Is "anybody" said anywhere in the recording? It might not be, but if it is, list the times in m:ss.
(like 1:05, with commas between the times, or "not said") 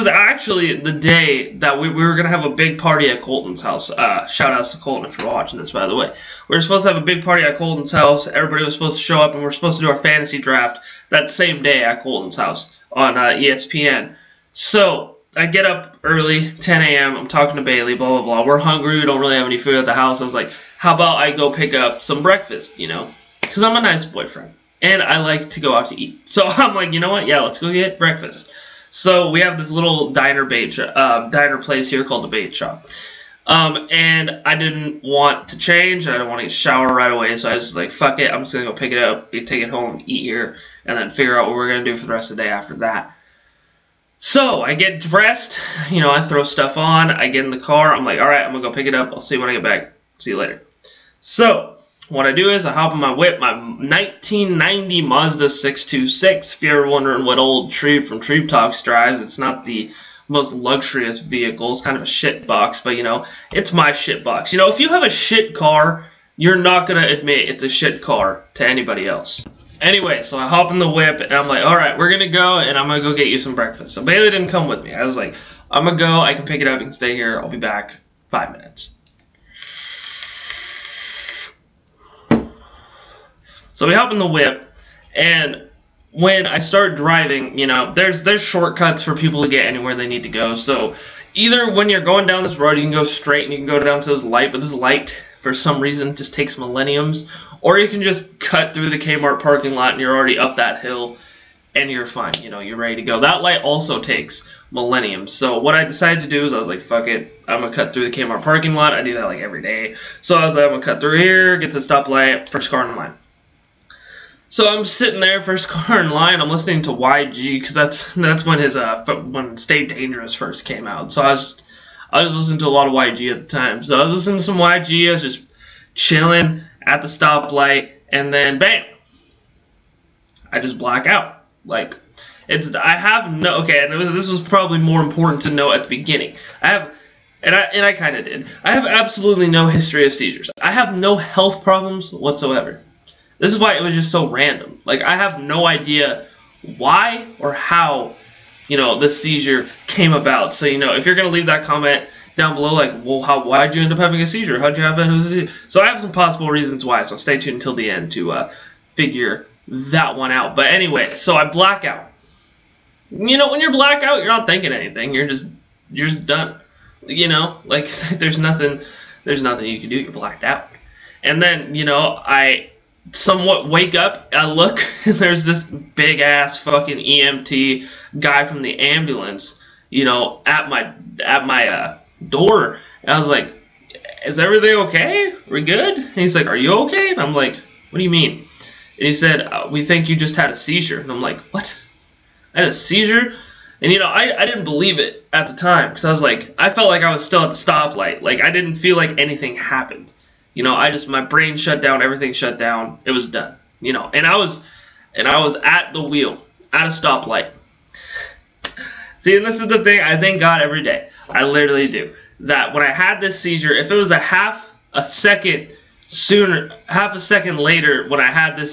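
1:08.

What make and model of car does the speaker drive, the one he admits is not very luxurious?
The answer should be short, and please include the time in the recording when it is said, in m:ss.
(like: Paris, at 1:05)
Mazda 626, at 0:55.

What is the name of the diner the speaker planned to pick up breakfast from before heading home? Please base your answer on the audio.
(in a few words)
The Bait Shop.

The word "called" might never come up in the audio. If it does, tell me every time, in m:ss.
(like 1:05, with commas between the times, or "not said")
0:32.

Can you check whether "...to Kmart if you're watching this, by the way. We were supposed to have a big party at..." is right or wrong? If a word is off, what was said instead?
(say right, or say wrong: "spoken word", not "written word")
wrong: "Colton", not "Kmart".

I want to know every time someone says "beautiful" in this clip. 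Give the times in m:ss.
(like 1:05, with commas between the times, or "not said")
not said.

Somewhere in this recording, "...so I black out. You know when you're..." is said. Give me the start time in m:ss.
2:41.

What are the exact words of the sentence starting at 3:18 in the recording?
Like I didn't feel like anything happened.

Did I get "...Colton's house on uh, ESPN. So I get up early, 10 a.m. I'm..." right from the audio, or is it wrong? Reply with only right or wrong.
right.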